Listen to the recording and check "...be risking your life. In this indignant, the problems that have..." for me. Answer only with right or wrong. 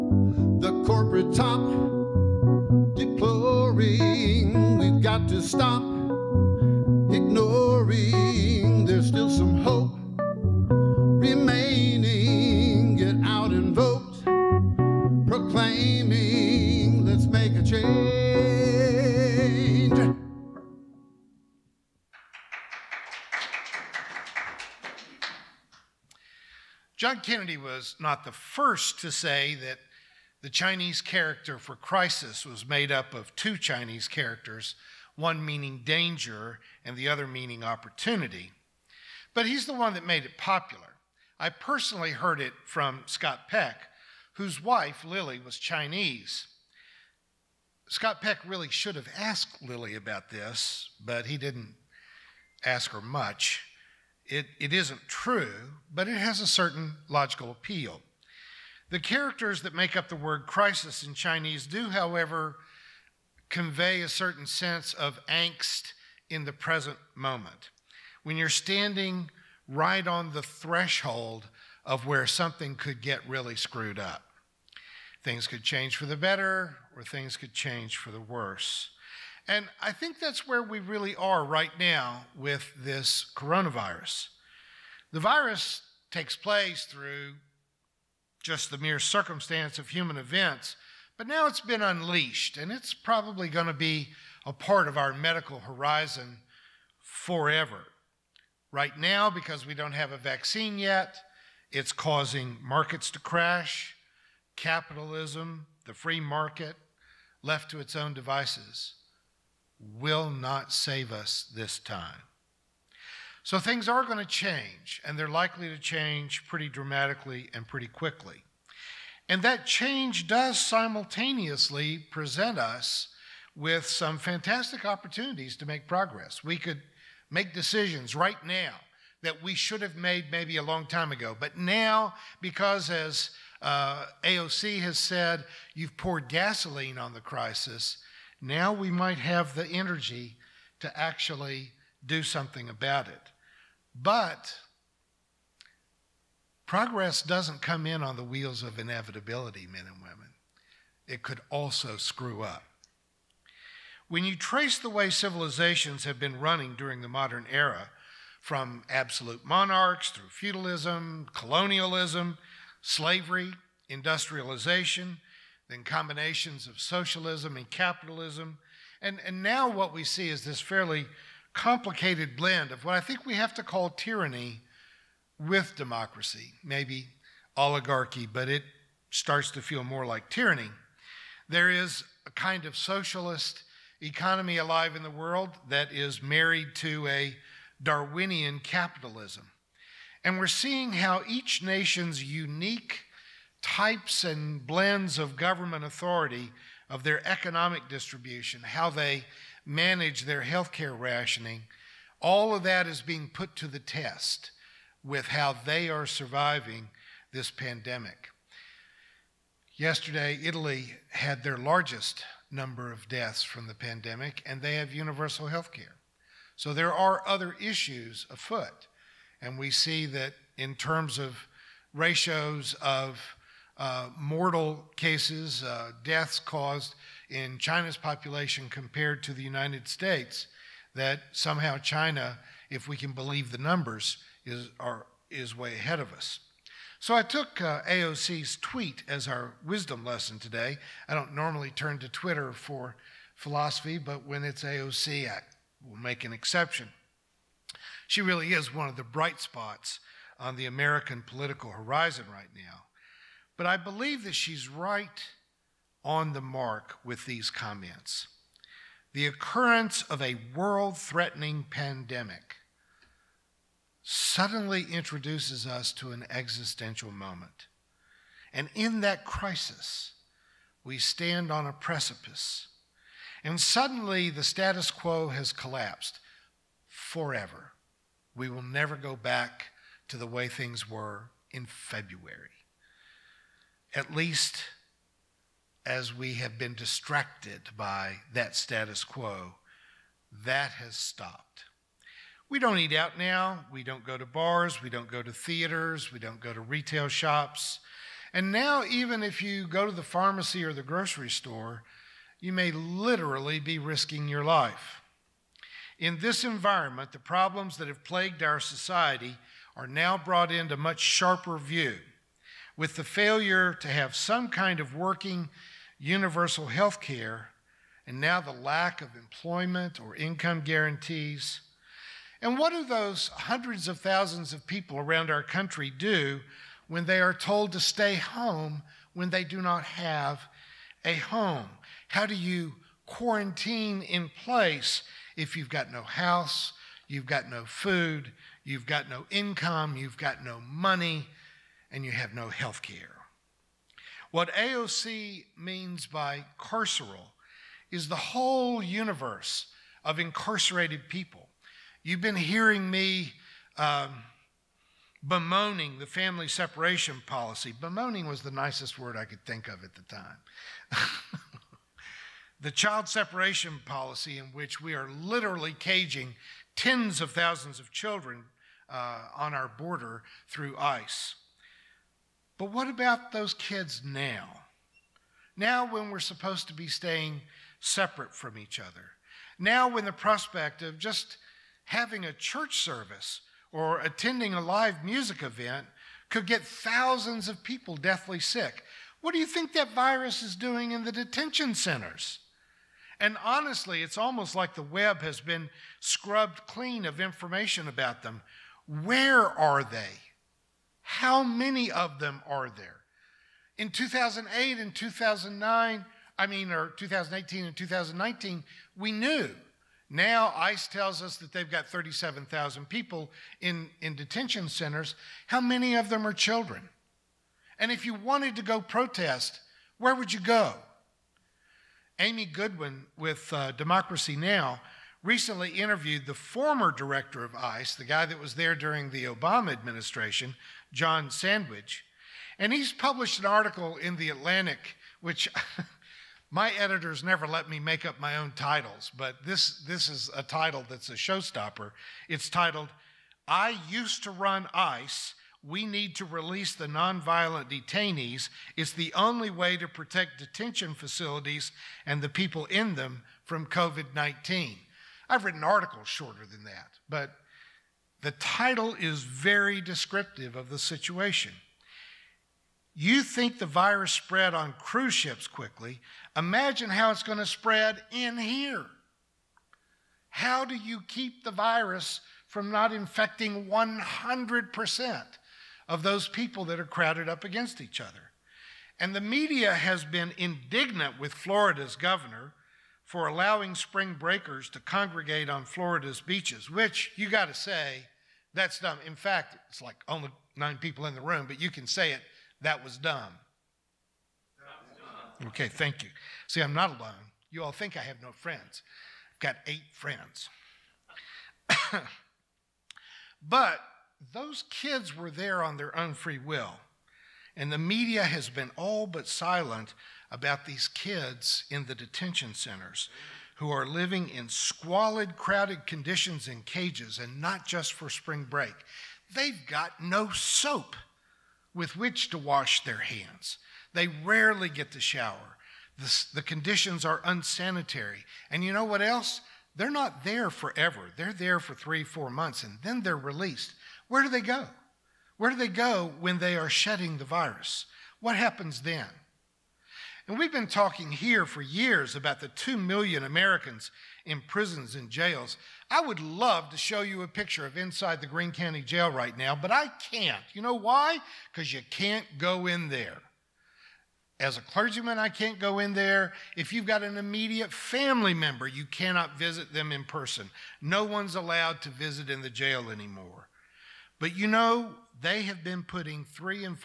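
wrong.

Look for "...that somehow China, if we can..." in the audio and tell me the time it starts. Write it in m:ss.
3:50.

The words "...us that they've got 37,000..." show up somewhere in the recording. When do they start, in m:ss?
6:51.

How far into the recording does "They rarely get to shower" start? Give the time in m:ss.
8:43.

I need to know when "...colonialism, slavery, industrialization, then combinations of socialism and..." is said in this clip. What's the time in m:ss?
2:41.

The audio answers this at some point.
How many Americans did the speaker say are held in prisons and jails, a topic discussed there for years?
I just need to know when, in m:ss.
9:02.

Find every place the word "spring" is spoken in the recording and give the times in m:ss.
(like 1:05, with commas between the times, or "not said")
8:03, 8:38.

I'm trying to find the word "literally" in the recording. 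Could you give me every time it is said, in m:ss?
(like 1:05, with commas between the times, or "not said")
5:02, 6:05.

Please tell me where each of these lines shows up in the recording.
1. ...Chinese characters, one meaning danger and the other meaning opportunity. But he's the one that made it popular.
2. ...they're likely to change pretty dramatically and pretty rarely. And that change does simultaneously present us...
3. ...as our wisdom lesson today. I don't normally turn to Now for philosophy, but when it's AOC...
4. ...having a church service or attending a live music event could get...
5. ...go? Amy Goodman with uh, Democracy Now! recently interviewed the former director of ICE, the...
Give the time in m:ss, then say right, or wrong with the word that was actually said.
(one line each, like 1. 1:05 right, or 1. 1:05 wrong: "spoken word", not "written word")
1. 0:33 right
2. 1:55 wrong: "quickly", not "rarely"
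3. 3:59 wrong: "Twitter", not "Now"
4. 6:21 right
5. 7:00 right.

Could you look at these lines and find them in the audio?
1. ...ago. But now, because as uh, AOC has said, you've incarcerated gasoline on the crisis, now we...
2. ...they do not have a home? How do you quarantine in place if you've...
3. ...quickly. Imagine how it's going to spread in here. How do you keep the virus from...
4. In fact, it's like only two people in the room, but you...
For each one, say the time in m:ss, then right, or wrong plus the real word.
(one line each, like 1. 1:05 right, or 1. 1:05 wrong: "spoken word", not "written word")
1. 2:11 wrong: "poured", not "incarcerated"
2. 5:29 right
3. 7:45 right
4. 8:09 wrong: "nine", not "two".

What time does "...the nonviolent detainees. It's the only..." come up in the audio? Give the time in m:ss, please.
7:26.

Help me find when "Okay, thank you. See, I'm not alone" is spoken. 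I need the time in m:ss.
8:15.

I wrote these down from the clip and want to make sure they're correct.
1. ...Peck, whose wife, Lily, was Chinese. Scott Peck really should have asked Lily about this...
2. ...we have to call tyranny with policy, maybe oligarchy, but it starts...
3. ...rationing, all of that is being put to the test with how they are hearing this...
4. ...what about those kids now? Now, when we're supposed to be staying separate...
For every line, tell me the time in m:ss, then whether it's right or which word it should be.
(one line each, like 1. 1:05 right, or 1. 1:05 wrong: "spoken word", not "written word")
1. 0:43 right
2. 2:53 wrong: "democracy", not "policy"
3. 3:20 wrong: "surviving", not "hearing"
4. 6:12 right.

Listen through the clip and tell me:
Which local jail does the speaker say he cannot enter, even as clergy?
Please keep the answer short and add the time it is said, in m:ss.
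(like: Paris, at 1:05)
Greene County Jail, at 9:08.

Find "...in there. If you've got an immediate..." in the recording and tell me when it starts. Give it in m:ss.
9:15.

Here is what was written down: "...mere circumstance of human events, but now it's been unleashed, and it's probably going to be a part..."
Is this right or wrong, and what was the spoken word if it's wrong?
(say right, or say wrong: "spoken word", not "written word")
right.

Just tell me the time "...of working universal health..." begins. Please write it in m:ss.
5:14.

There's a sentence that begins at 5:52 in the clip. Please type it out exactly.
You've been hearing me um, bemoaning the family separation policy.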